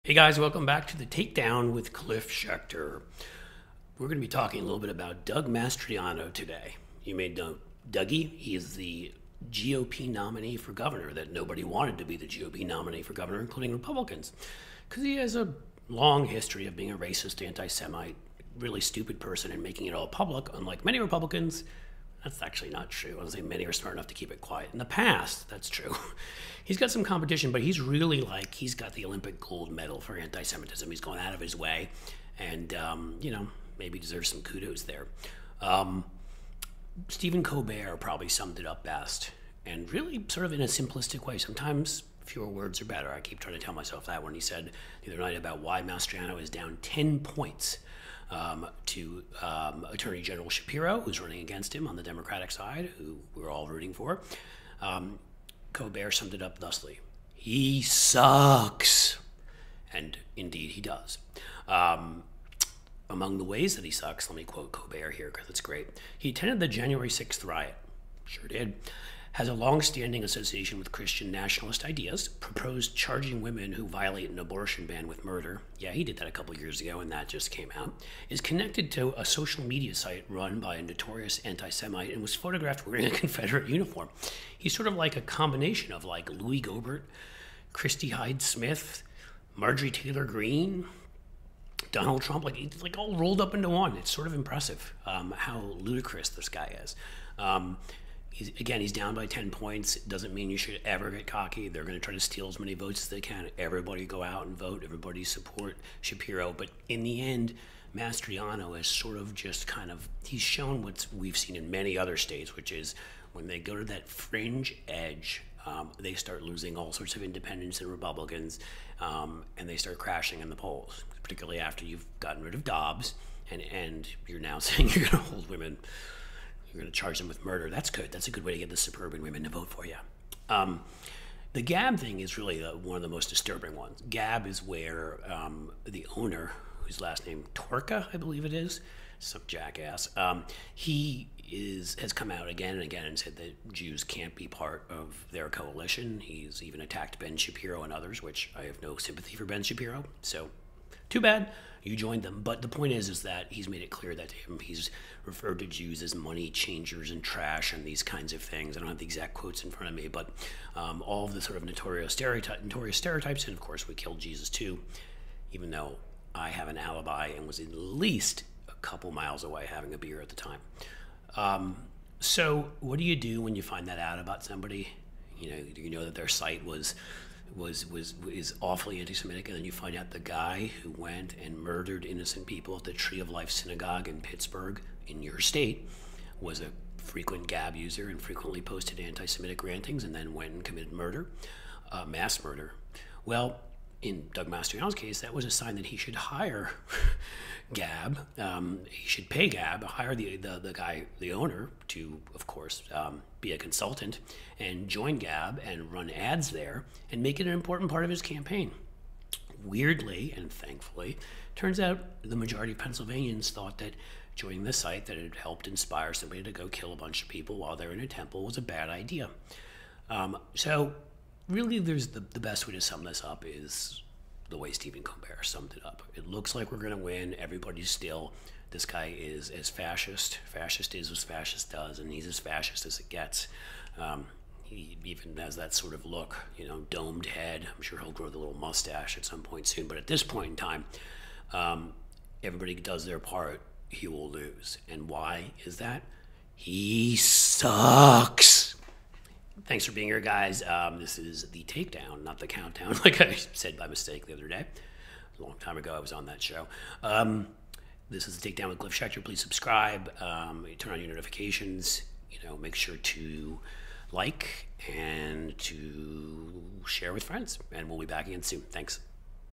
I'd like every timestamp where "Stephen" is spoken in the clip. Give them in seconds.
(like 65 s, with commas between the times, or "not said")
37 s, 224 s.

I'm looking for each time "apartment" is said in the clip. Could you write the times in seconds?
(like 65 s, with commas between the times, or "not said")
not said.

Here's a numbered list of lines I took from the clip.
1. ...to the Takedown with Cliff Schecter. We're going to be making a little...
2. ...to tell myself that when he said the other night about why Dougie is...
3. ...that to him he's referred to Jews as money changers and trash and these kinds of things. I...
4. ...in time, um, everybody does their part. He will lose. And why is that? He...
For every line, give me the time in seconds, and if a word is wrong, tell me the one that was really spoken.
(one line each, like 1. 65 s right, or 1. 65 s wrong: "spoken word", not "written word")
1. 0 s wrong: "talking", not "making"
2. 43 s wrong: "Mastriano", not "Dougie"
3. 154 s right
4. 240 s right.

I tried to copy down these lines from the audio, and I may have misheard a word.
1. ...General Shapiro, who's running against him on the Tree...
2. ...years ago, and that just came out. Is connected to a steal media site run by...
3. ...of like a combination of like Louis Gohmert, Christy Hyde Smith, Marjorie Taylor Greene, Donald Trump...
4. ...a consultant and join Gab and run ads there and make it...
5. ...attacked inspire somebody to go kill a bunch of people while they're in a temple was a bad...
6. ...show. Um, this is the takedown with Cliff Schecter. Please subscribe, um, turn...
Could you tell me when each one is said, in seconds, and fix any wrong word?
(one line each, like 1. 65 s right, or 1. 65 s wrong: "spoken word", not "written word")
1. 50 s wrong: "Democratic", not "Tree"
2. 76 s wrong: "social", not "steal"
3. 84 s right
4. 203 s right
5. 215 s wrong: "helped", not "attacked"
6. 256 s right.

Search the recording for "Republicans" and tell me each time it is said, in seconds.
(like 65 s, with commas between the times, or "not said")
13 s, 20 s, 117 s.